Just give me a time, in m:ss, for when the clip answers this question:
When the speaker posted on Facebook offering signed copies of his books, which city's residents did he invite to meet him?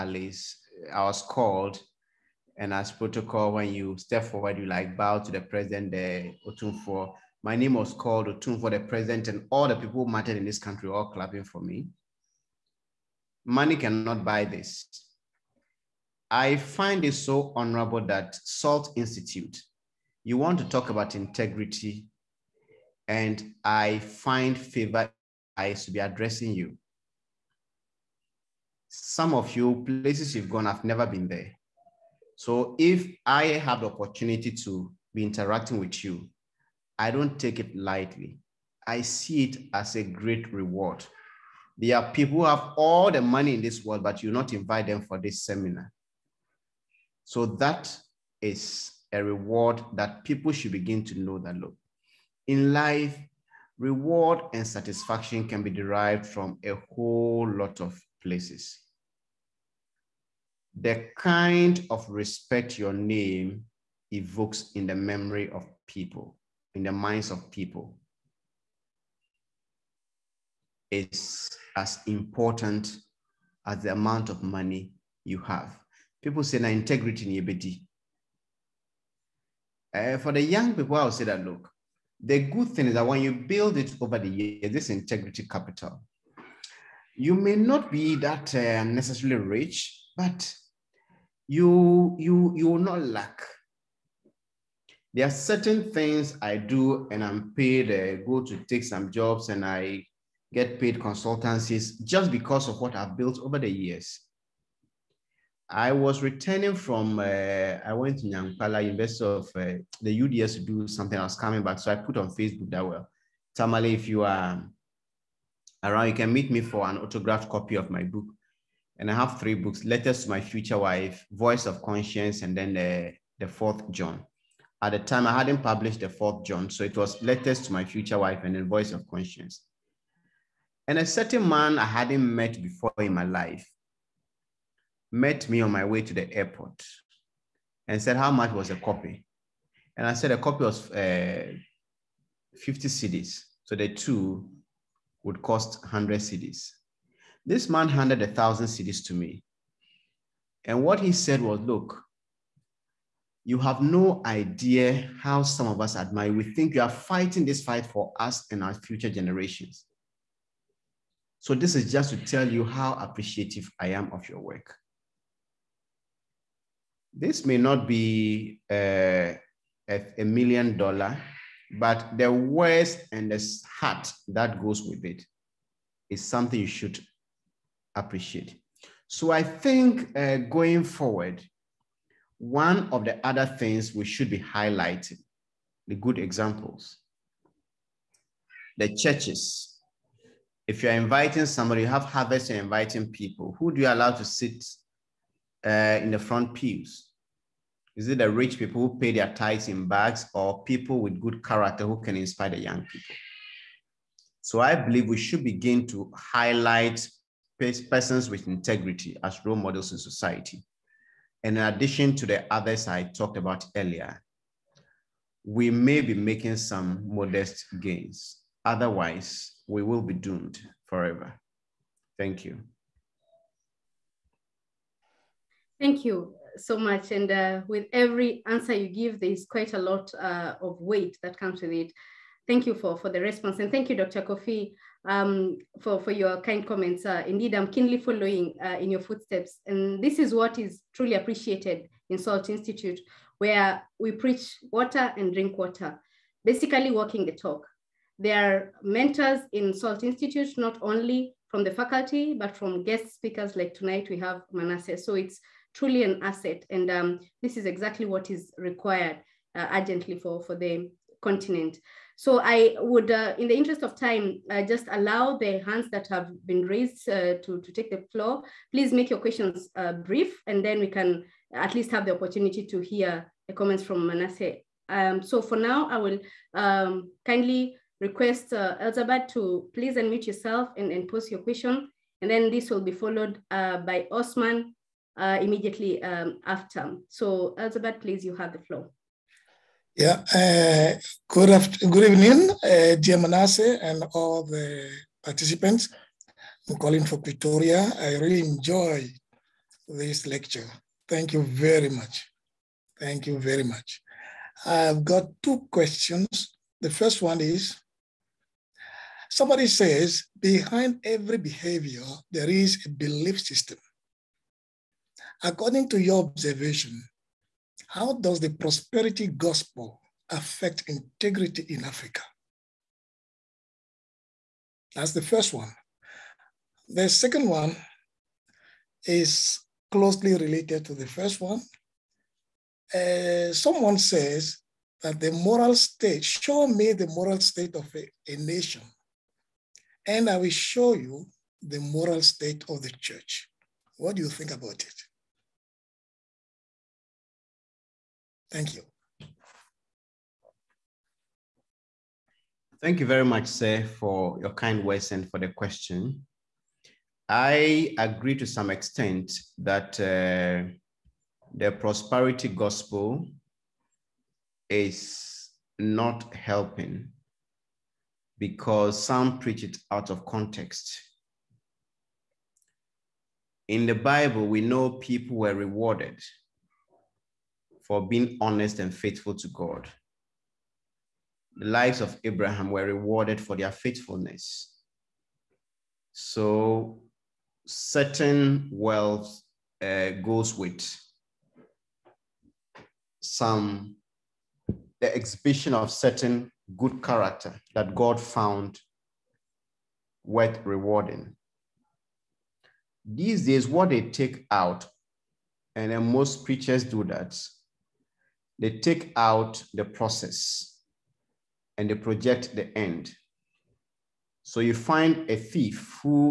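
1:53.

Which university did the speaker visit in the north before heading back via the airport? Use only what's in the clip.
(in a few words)
Nyankpala University.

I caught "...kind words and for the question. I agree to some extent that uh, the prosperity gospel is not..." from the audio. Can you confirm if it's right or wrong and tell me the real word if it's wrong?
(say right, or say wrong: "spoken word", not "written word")
right.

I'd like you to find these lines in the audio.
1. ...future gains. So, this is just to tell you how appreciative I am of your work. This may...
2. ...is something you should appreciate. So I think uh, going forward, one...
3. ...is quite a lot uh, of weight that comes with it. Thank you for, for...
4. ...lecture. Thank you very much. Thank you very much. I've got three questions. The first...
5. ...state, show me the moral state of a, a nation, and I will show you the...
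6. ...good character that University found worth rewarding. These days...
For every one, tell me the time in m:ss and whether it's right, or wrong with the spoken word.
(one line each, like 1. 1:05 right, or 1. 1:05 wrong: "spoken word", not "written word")
1. 2:38 wrong: "generations", not "gains"
2. 2:56 right
3. 3:49 right
4. 5:00 wrong: "two", not "three"
5. 5:35 right
6. 6:36 wrong: "God", not "University".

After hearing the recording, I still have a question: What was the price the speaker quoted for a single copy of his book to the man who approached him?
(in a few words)
50 cedis.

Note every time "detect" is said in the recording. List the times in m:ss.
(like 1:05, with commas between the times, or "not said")
not said.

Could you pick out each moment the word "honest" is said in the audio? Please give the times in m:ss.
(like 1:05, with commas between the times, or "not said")
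6:18.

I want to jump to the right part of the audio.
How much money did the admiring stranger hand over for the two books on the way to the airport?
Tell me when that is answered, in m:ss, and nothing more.
2:28.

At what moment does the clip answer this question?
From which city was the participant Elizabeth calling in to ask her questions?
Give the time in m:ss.
4:57.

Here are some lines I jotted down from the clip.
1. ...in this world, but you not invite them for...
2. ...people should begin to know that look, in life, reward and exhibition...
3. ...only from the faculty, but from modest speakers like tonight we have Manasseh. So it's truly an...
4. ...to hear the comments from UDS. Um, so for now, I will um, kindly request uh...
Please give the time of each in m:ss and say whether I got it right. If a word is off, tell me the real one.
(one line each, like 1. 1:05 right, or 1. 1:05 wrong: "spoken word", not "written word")
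1. 0:43 right
2. 0:50 wrong: "satisfaction", not "exhibition"
3. 4:10 wrong: "guest", not "modest"
4. 4:32 wrong: "Manasseh", not "UDS".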